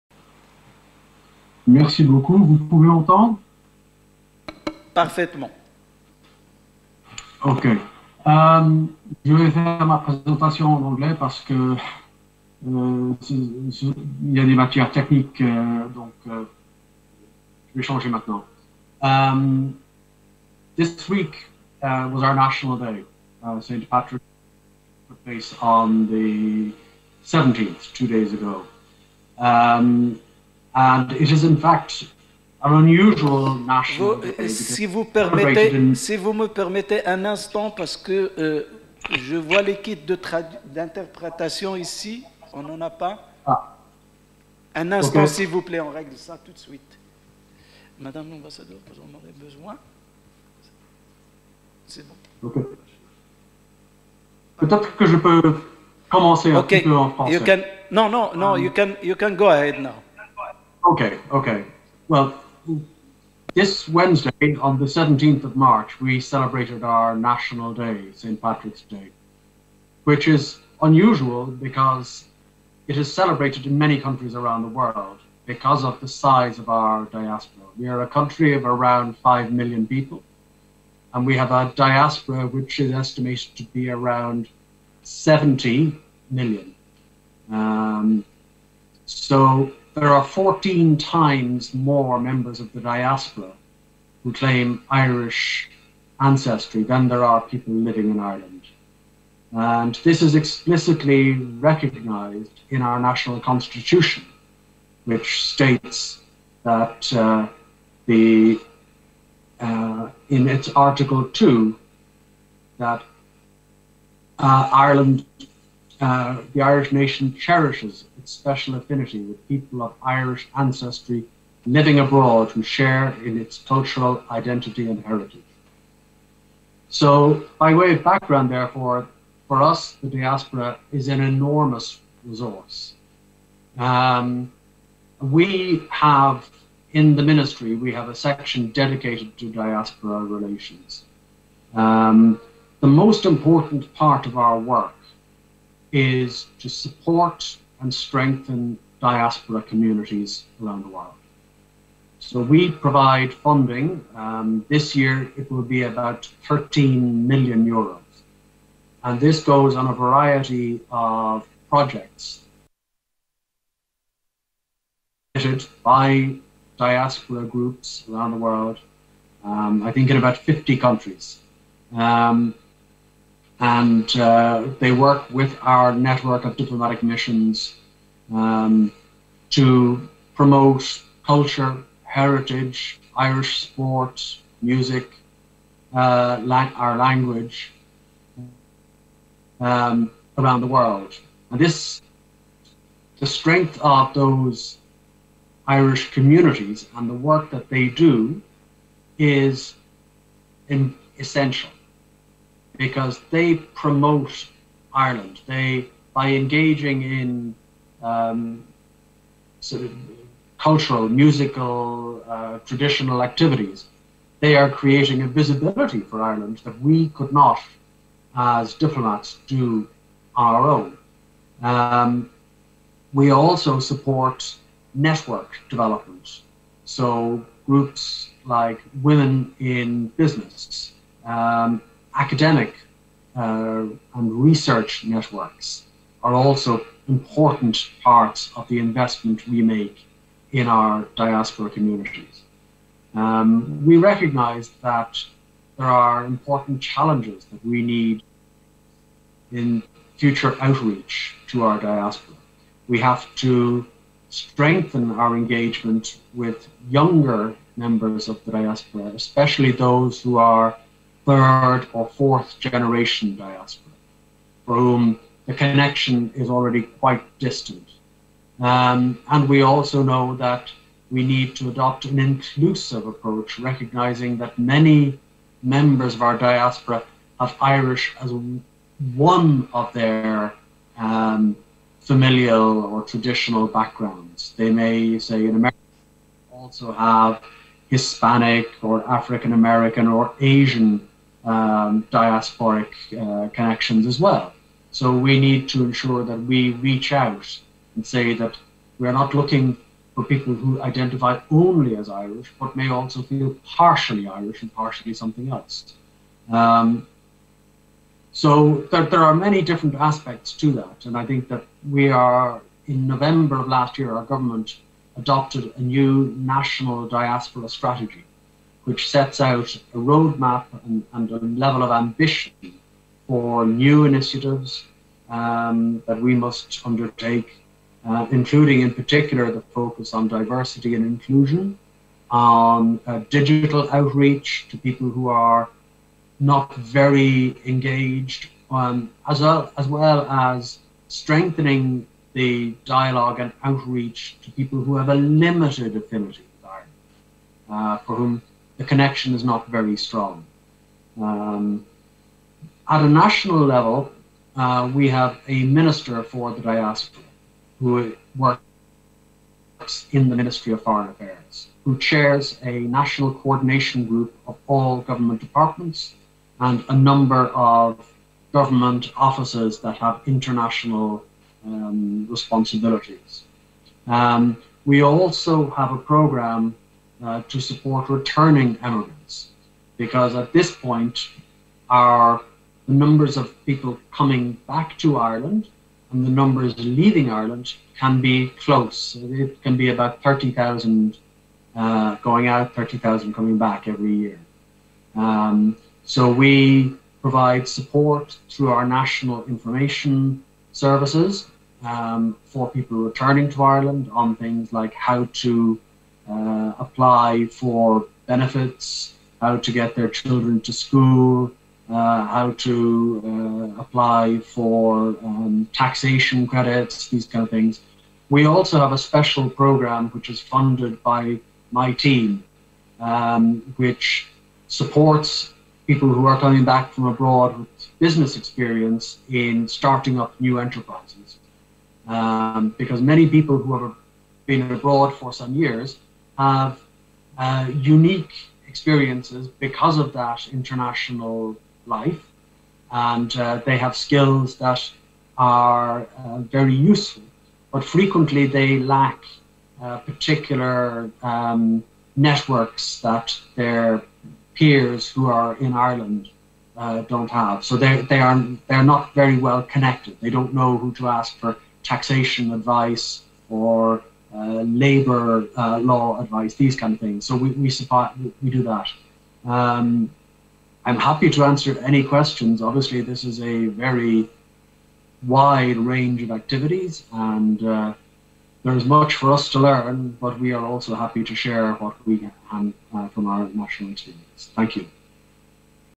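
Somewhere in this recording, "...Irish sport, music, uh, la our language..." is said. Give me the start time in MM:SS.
03:03.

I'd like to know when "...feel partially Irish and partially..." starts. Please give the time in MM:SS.
05:03.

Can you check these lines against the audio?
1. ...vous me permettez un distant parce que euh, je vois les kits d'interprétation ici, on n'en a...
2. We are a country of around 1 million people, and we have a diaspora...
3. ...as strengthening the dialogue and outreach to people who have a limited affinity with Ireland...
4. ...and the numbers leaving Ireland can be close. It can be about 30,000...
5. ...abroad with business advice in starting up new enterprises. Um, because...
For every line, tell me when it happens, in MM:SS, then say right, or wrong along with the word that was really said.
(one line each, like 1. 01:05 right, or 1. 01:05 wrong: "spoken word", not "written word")
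1. 00:34 wrong: "instant", not "distant"
2. 01:17 wrong: "5", not "1"
3. 05:40 right
4. 06:26 right
5. 07:07 wrong: "experience", not "advice".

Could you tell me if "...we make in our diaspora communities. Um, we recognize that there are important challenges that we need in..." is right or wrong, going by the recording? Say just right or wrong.
right.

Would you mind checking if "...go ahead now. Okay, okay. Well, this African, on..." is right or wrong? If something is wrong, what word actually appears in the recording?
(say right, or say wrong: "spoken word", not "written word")
wrong: "Wednesday", not "African".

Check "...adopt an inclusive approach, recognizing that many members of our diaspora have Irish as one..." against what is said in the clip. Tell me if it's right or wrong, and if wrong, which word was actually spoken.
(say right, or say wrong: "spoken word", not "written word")
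right.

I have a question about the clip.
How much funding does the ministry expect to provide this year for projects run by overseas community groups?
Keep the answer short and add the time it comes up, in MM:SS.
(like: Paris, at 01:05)
13 million euros, at 02:36.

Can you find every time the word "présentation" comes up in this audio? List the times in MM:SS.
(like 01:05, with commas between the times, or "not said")
00:09.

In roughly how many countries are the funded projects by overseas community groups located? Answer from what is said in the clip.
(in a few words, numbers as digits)
50.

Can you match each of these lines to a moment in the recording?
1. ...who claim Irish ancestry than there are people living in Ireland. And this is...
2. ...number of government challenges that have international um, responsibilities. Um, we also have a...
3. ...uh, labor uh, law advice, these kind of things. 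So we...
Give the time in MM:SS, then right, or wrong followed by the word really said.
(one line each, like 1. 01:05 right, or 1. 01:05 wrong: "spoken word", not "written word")
1. 01:34 right
2. 06:07 wrong: "offices", not "challenges"
3. 07:44 right.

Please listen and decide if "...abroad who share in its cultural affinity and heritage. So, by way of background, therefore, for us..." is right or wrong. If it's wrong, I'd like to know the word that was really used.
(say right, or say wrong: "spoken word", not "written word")
wrong: "identity", not "affinity".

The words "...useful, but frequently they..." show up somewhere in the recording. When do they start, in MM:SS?
07:26.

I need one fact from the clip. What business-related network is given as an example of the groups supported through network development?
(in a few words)
Women in Business.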